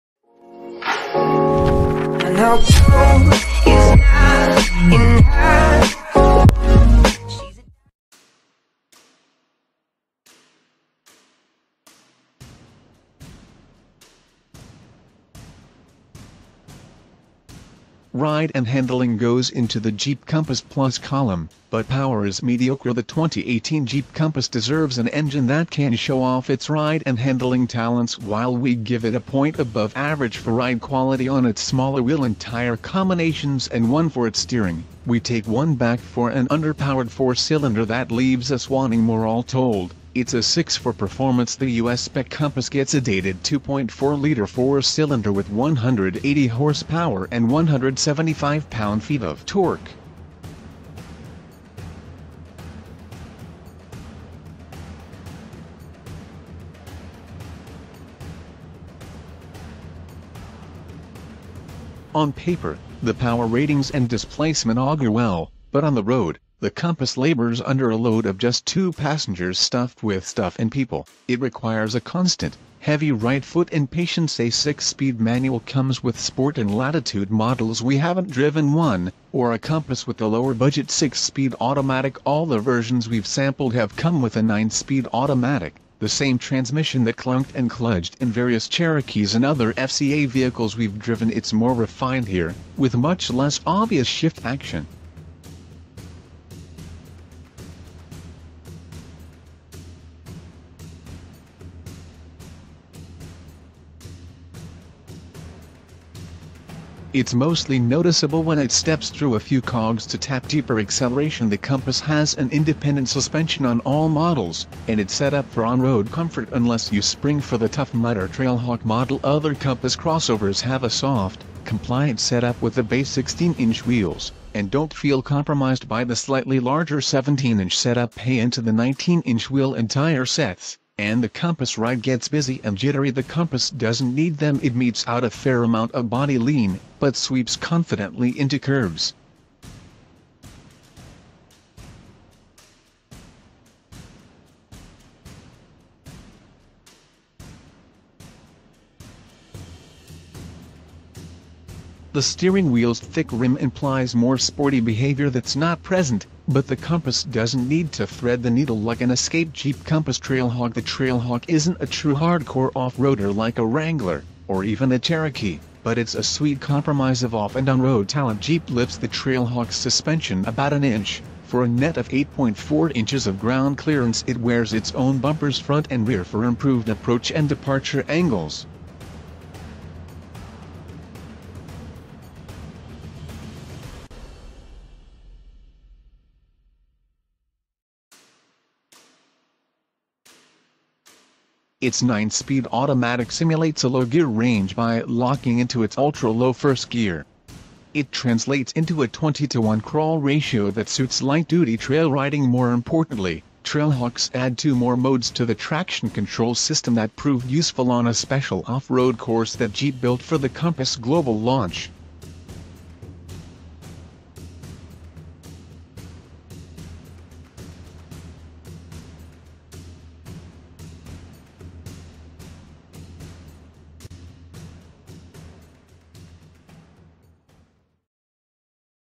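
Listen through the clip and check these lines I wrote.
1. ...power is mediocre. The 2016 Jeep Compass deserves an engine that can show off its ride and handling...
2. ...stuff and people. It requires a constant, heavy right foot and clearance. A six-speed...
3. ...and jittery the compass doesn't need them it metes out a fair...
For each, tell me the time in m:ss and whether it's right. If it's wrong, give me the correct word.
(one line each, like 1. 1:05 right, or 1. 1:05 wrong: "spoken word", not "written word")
1. 0:21 wrong: "2018", not "2016"
2. 1:10 wrong: "patience", not "clearance"
3. 2:12 right.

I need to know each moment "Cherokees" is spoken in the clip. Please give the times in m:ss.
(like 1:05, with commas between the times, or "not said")
1:28, 2:44.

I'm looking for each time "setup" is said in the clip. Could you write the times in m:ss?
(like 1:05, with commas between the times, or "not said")
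2:02, 2:07.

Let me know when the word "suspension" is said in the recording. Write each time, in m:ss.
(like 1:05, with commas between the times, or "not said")
1:53, 2:49.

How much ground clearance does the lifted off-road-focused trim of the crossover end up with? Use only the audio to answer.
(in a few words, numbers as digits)
8.4 inches.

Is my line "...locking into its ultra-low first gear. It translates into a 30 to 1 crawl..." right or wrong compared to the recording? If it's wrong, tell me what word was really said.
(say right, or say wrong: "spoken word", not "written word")
wrong: "20", not "30".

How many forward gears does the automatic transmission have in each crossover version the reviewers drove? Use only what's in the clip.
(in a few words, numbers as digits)
9.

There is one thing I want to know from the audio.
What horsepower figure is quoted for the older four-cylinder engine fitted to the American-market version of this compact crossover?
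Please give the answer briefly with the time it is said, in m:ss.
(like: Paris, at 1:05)
180, at 0:45.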